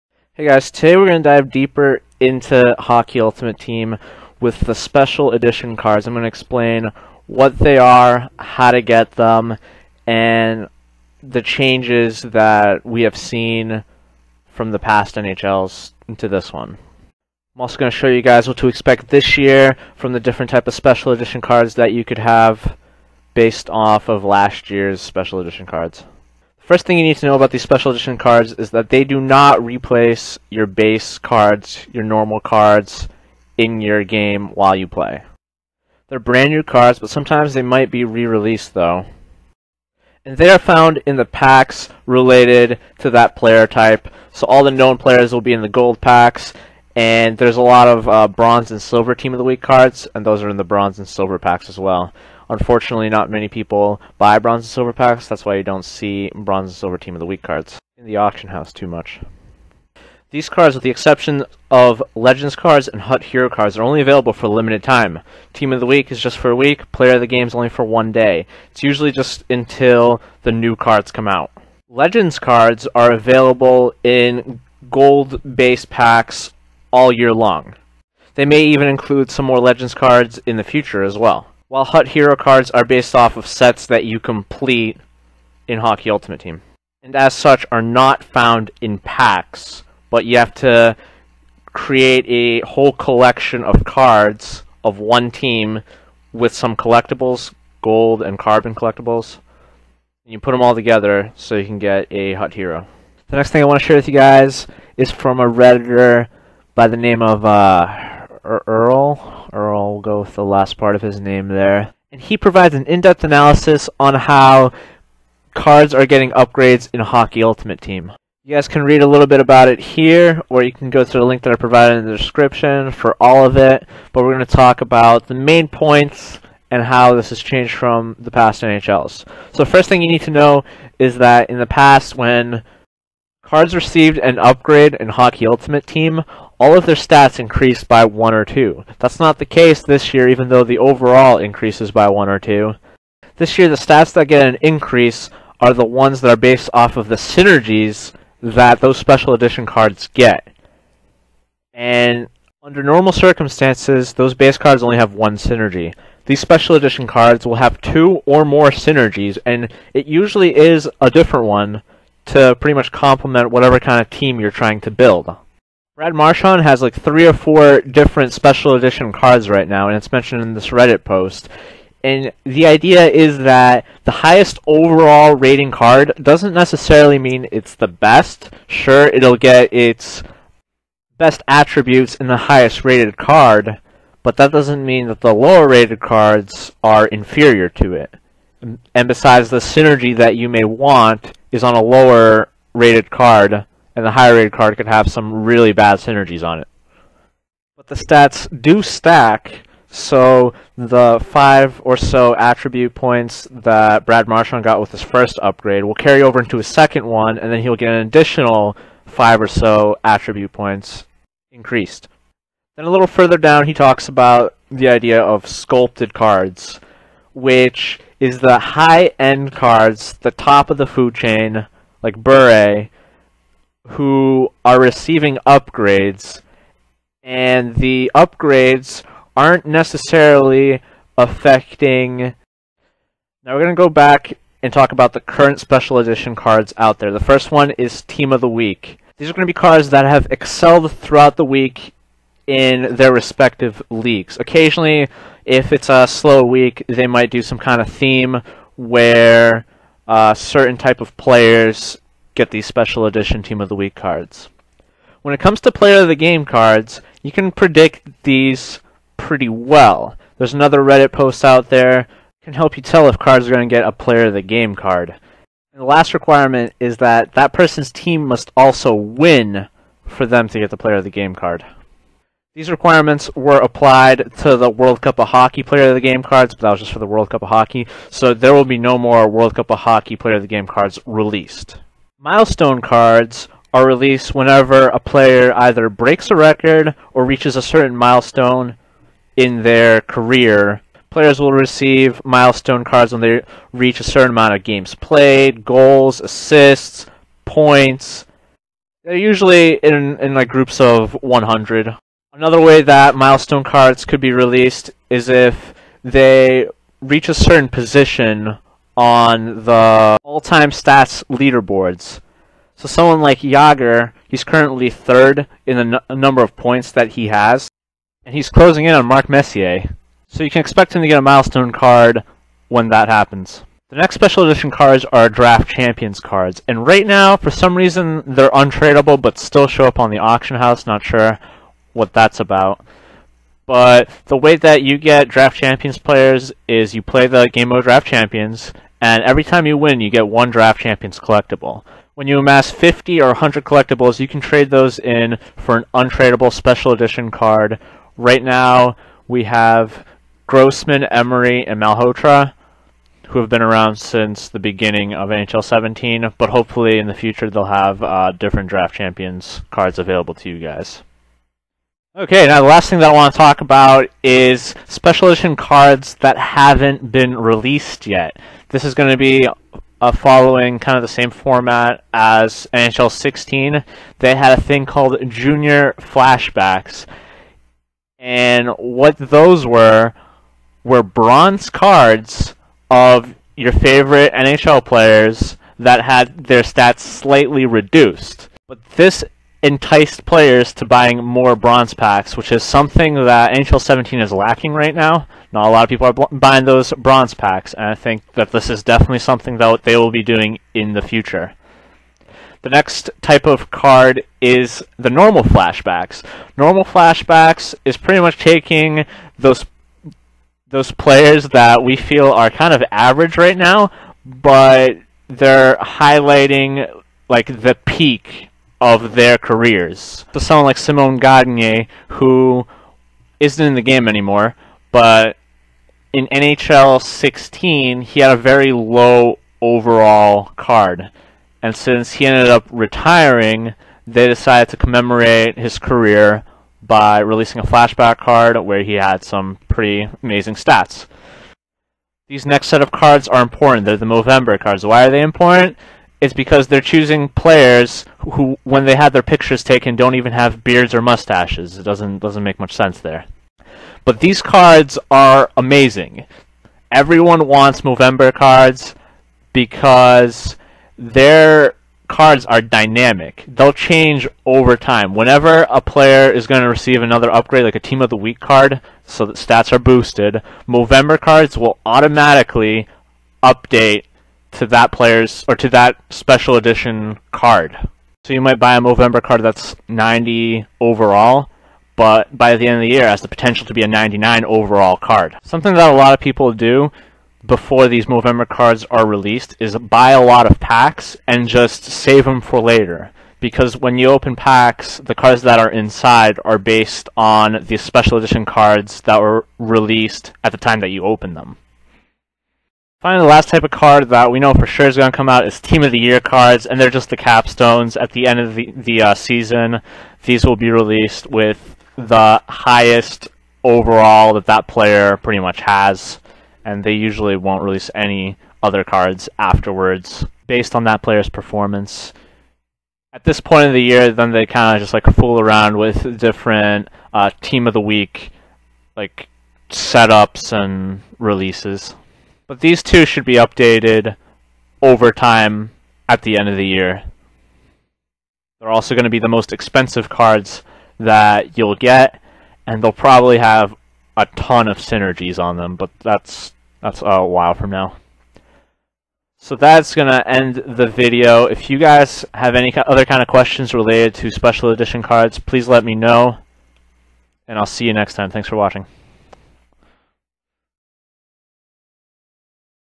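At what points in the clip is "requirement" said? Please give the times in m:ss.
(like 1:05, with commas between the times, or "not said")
4:26, 4:32.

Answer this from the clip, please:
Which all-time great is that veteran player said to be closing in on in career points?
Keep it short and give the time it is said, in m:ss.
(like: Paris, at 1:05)
Mark Messier, at 5:19.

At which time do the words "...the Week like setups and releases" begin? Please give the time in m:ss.
8:47.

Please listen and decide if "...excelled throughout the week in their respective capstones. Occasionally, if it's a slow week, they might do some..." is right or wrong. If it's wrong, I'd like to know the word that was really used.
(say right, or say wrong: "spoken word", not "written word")
wrong: "leagues", not "capstones".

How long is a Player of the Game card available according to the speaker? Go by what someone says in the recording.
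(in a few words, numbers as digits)
one day.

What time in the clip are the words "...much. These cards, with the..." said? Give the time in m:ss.
0:58.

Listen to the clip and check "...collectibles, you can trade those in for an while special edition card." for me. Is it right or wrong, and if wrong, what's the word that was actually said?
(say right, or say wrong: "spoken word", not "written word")
wrong: "untradeable", not "while".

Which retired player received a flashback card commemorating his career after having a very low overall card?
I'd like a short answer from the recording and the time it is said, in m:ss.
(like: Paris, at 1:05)
Simon Gagne, at 7:00.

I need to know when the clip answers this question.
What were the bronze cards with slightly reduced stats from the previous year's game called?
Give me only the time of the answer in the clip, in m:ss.
6:15.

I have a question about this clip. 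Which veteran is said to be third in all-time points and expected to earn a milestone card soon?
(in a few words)
Jagr.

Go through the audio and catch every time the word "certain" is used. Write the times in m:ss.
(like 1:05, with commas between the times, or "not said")
4:10, 4:47, 4:54, 5:07.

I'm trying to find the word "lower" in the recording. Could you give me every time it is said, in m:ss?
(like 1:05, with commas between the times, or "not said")
3:05, 3:11.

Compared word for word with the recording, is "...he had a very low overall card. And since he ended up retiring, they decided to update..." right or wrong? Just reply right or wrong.
wrong.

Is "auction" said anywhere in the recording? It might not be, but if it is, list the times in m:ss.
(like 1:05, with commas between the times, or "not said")
0:58, 5:30.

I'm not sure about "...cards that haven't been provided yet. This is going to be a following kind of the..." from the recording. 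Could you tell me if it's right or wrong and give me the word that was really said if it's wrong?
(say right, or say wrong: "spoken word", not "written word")
wrong: "released", not "provided".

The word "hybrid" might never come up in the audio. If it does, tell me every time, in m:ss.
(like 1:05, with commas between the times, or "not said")
not said.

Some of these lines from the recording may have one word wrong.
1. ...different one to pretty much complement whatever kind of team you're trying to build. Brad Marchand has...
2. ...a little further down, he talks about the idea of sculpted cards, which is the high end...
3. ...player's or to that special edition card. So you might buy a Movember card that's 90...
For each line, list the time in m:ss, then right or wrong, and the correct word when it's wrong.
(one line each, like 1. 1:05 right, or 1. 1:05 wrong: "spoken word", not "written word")
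1. 2:41 right
2. 3:32 right
3. 7:54 right.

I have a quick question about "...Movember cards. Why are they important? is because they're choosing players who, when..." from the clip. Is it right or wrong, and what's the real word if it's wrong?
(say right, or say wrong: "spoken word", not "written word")
right.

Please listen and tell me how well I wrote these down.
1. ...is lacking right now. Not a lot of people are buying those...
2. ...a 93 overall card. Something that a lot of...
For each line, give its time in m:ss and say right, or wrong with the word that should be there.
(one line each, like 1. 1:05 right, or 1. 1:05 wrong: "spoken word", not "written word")
1. 6:34 right
2. 8:03 wrong: "99", not "93".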